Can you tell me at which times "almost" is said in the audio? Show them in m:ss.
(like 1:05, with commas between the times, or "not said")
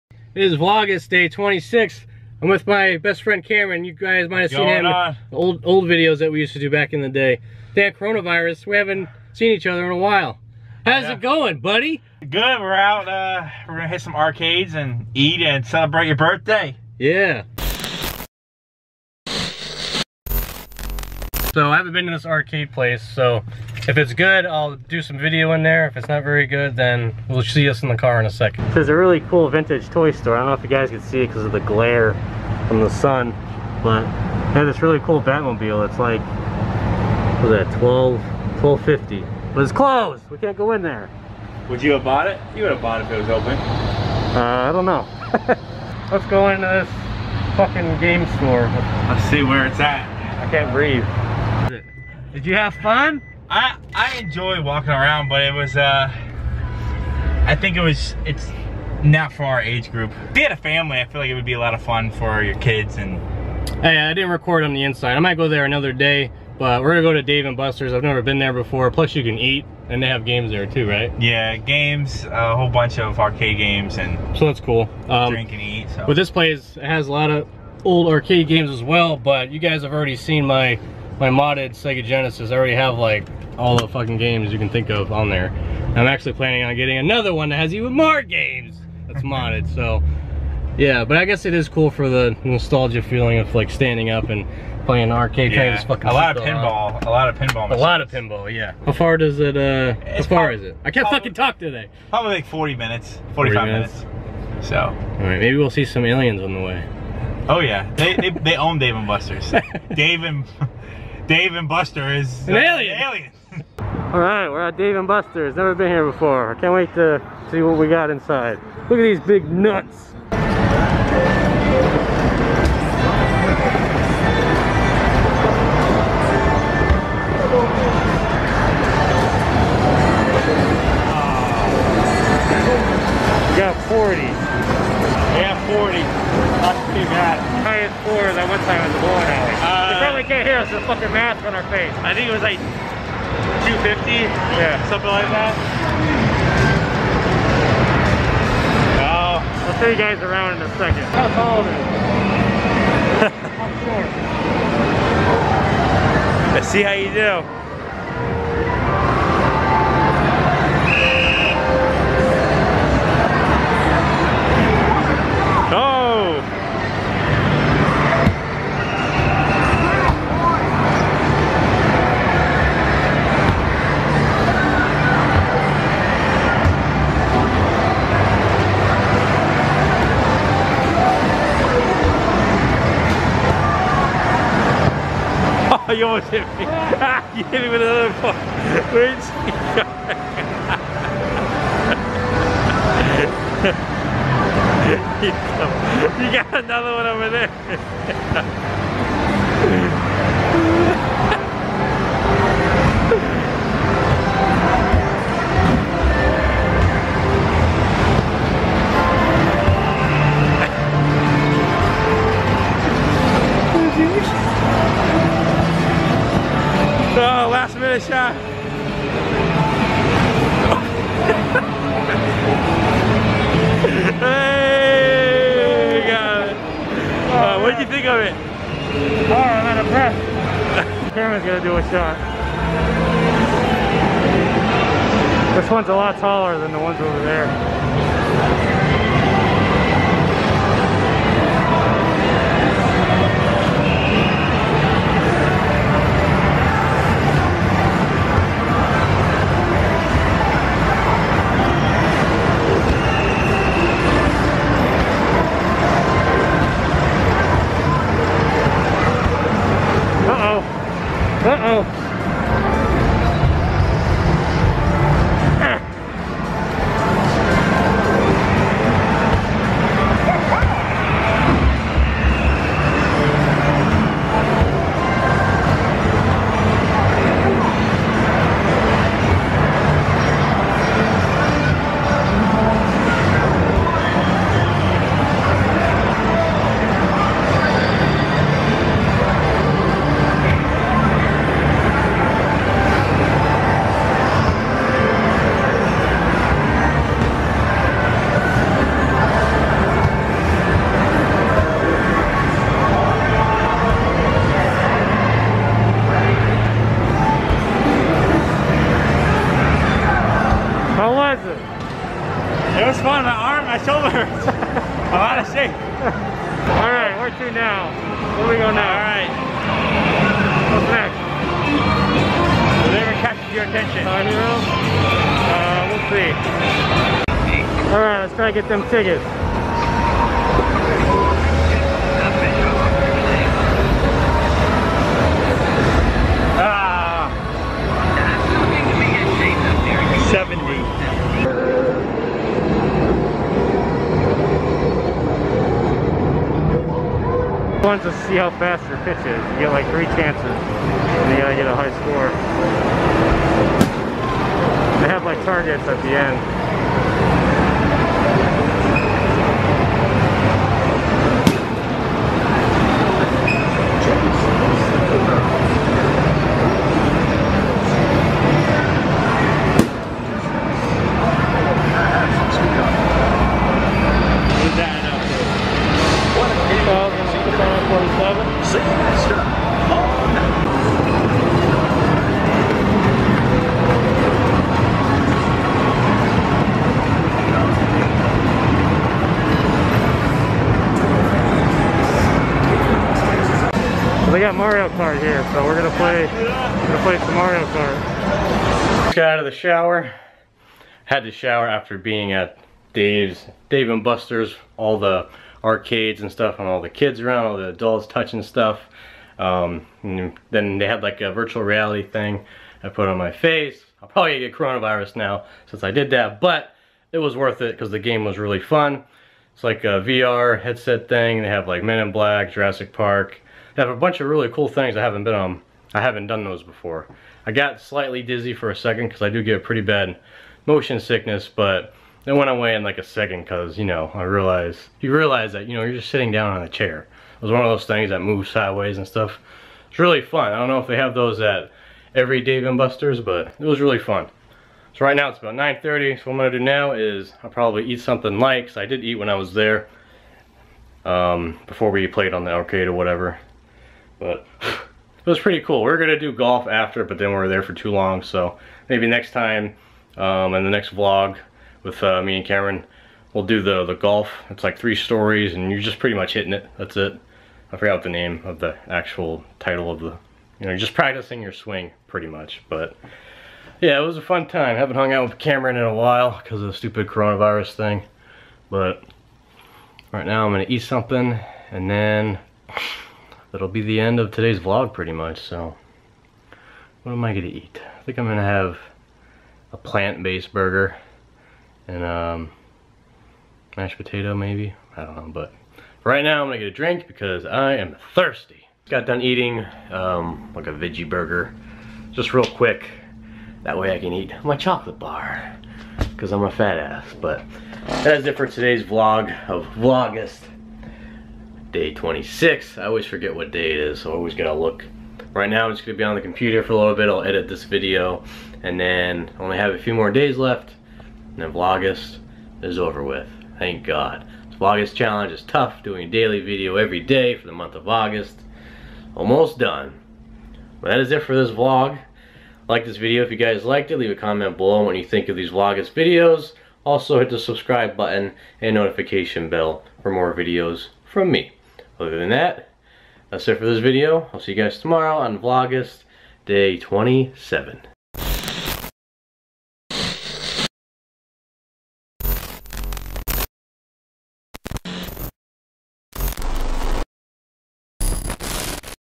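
3:06, 8:49.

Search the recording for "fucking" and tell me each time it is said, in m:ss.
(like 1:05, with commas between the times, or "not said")
0:47, 1:23, 1:35, 1:41, 2:20.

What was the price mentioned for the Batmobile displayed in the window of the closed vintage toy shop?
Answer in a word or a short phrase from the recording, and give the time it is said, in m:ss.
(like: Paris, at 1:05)
1250, at 0:38.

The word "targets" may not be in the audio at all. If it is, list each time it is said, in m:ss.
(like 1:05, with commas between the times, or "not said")
5:55.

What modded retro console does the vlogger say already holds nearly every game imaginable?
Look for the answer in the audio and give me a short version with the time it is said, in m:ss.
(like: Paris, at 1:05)
Sega Genesis, at 1:21.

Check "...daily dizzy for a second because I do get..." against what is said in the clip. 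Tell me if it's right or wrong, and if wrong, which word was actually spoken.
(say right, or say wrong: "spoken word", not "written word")
wrong: "slightly", not "daily".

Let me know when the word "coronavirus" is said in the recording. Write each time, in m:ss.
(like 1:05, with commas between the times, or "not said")
0:07, 6:54, 7:57.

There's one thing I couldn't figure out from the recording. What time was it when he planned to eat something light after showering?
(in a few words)
9:30.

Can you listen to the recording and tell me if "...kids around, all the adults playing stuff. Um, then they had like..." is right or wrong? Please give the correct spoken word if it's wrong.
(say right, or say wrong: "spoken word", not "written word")
wrong: "touching", not "playing".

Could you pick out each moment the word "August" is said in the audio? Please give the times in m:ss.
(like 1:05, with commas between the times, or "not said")
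8:47.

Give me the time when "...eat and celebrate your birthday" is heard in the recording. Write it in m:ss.
0:15.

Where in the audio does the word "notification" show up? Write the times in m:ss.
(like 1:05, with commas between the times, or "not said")
8:58.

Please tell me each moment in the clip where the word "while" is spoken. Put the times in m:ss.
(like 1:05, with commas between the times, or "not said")
0:09, 7:55.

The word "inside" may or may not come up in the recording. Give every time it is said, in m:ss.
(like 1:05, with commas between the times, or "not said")
1:04, 1:58.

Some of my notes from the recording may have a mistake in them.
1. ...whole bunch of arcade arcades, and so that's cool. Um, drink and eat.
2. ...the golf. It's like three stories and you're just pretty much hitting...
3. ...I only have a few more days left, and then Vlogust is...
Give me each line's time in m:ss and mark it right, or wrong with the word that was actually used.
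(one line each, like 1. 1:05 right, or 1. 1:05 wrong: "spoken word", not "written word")
1. 1:12 wrong: "games", not "arcades"
2. 7:43 right
3. 8:39 right.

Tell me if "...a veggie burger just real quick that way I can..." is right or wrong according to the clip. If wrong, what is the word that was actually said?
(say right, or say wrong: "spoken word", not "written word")
right.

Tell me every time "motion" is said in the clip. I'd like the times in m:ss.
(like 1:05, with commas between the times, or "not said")
7:10.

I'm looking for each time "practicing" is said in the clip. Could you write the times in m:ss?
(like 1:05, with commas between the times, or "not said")
7:50.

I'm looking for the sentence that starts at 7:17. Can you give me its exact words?
It was one of those things that moves sideways and stuff.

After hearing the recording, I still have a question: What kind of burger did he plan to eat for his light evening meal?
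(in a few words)
Plant-based burger.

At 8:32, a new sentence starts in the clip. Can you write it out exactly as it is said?
I always forget what day it is, so I always gotta look.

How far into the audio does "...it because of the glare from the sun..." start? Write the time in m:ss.
0:31.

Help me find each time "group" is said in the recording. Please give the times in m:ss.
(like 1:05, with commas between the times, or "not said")
0:59.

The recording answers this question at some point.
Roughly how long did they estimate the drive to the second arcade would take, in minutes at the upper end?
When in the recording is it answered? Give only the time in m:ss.
1:43.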